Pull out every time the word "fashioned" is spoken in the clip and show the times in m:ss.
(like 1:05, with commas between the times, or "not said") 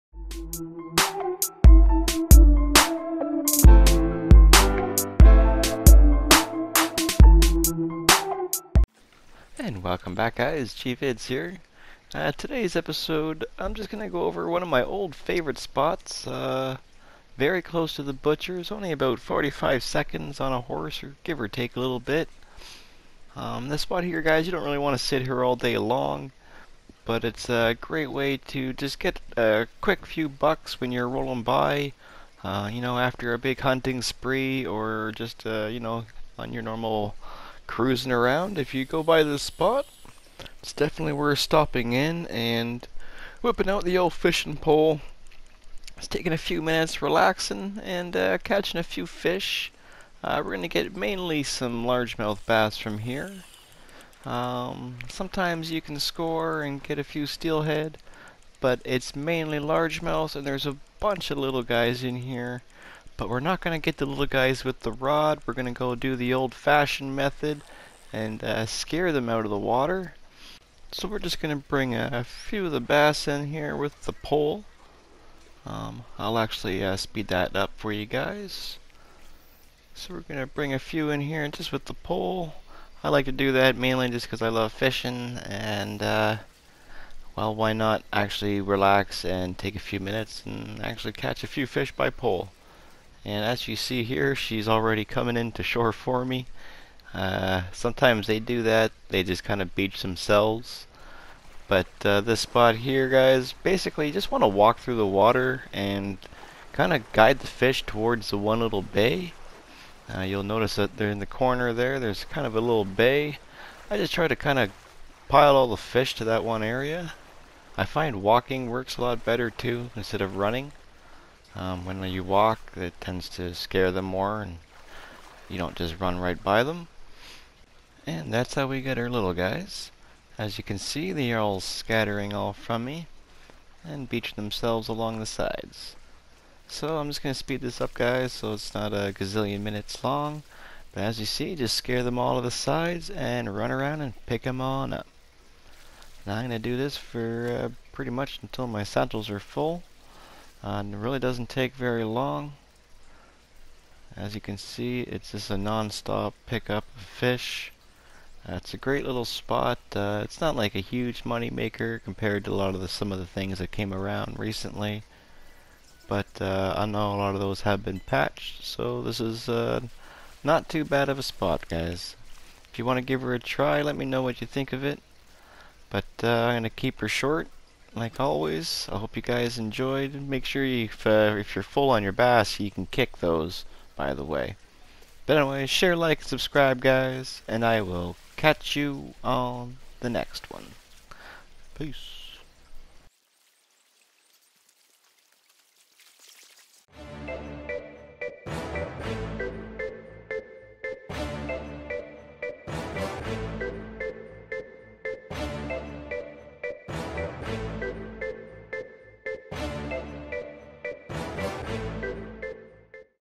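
1:06.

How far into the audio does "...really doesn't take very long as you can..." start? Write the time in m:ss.
2:30.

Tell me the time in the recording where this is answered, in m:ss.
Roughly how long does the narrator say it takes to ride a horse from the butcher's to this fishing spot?
0:19.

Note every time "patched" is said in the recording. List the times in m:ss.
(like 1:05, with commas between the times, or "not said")
2:48.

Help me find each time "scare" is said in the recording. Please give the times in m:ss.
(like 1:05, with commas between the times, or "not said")
1:08, 2:03, 2:21.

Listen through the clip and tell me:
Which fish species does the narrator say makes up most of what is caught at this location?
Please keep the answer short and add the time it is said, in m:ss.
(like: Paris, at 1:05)
largemouth bass, at 0:51.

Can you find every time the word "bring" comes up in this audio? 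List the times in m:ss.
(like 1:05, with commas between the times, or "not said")
1:11, 1:20.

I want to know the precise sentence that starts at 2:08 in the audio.
And that's how we get our little guys.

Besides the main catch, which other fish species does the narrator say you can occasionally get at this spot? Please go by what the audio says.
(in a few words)
steelhead.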